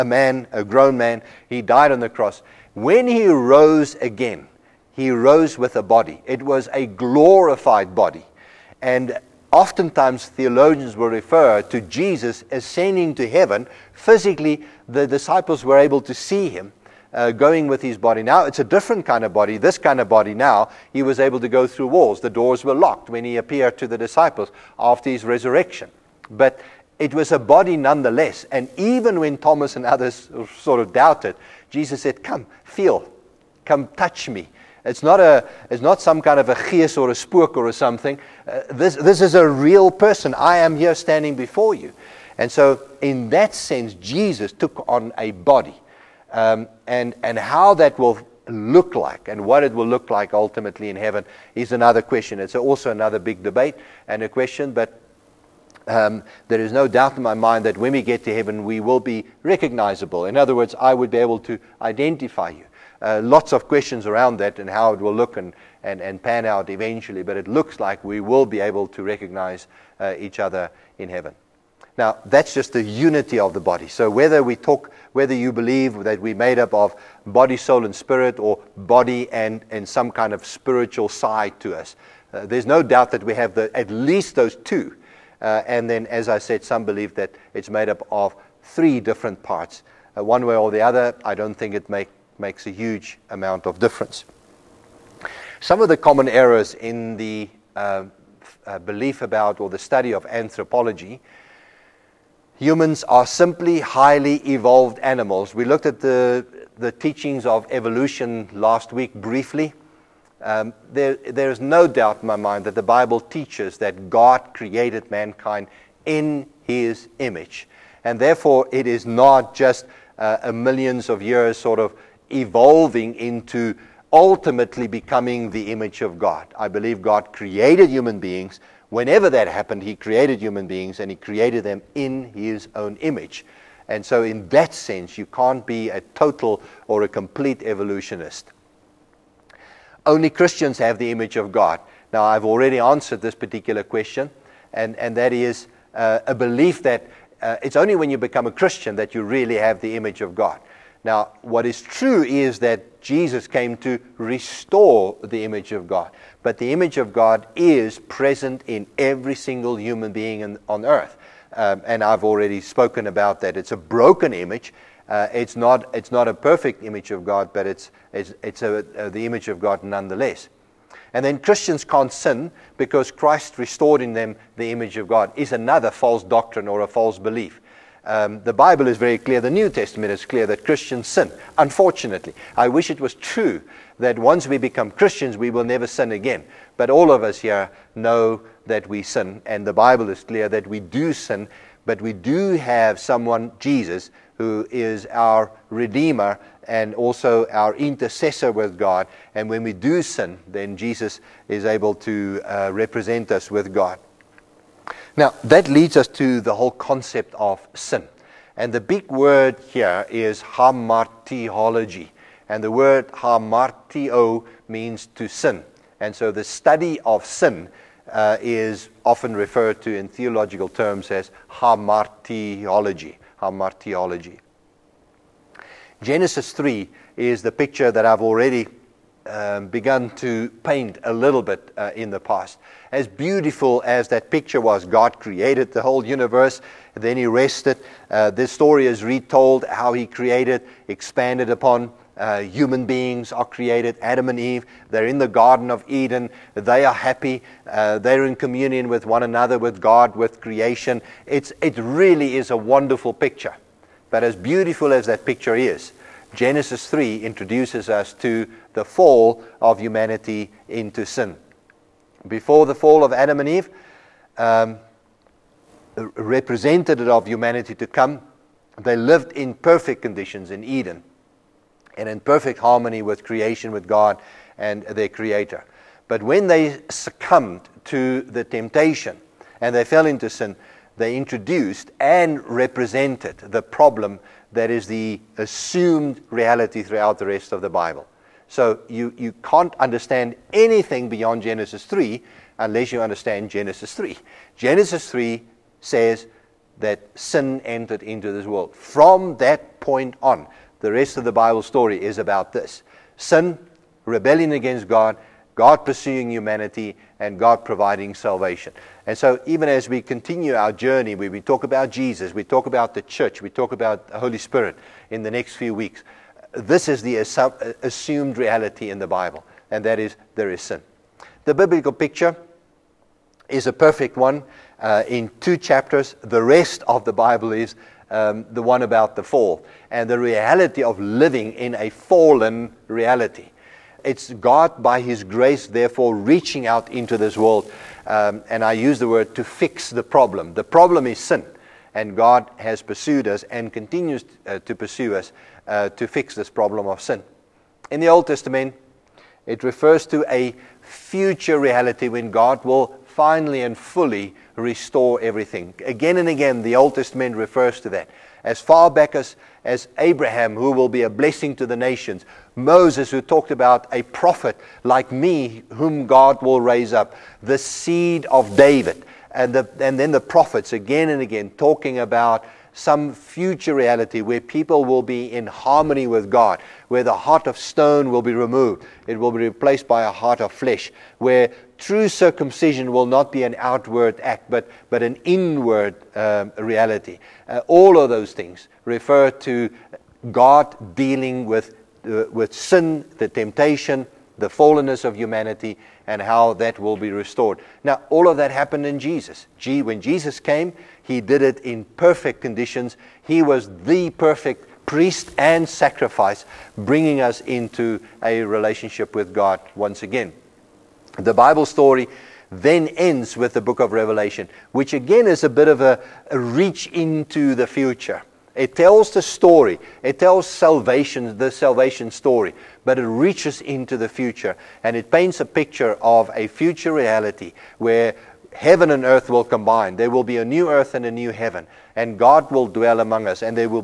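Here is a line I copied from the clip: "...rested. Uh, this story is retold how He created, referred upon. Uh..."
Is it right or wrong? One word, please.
wrong.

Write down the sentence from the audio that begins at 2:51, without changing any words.
And then Christians can't sin because Christ restored in them the image of God, is another false doctrine or a false belief.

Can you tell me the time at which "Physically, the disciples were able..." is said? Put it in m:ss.
0:13.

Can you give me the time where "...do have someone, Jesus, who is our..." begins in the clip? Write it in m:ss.
3:12.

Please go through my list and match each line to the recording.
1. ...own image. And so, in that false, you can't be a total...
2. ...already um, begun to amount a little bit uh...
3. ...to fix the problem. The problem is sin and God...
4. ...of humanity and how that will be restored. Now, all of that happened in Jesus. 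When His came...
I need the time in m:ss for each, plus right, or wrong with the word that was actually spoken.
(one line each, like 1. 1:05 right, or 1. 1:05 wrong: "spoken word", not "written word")
1. 2:12 wrong: "sense", not "false"
2. 3:48 wrong: "paint", not "amount"
3. 5:39 right
4. 6:35 wrong: "Jesus", not "His".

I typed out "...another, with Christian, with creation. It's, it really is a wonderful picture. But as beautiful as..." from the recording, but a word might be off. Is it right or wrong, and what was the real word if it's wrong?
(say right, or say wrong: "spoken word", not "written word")
wrong: "God", not "Christian".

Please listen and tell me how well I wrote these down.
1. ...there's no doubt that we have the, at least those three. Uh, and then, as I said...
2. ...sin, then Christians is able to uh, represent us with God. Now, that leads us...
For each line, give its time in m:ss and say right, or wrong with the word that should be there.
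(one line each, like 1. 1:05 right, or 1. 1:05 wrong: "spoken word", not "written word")
1. 1:22 wrong: "two", not "three"
2. 3:20 wrong: "Jesus", not "Christians".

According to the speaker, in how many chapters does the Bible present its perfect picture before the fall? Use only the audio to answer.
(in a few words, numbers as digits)
2.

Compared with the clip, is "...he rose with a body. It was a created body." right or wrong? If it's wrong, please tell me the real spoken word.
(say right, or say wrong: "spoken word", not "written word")
wrong: "glorified", not "created".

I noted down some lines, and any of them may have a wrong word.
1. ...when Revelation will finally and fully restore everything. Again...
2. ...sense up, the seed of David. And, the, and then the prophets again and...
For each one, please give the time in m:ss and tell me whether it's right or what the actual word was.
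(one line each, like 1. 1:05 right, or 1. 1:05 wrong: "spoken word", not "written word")
1. 5:52 wrong: "God", not "Revelation"
2. 6:06 wrong: "raise", not "sense".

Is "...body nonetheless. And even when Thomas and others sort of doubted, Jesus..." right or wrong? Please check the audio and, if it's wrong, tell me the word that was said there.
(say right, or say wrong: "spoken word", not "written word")
right.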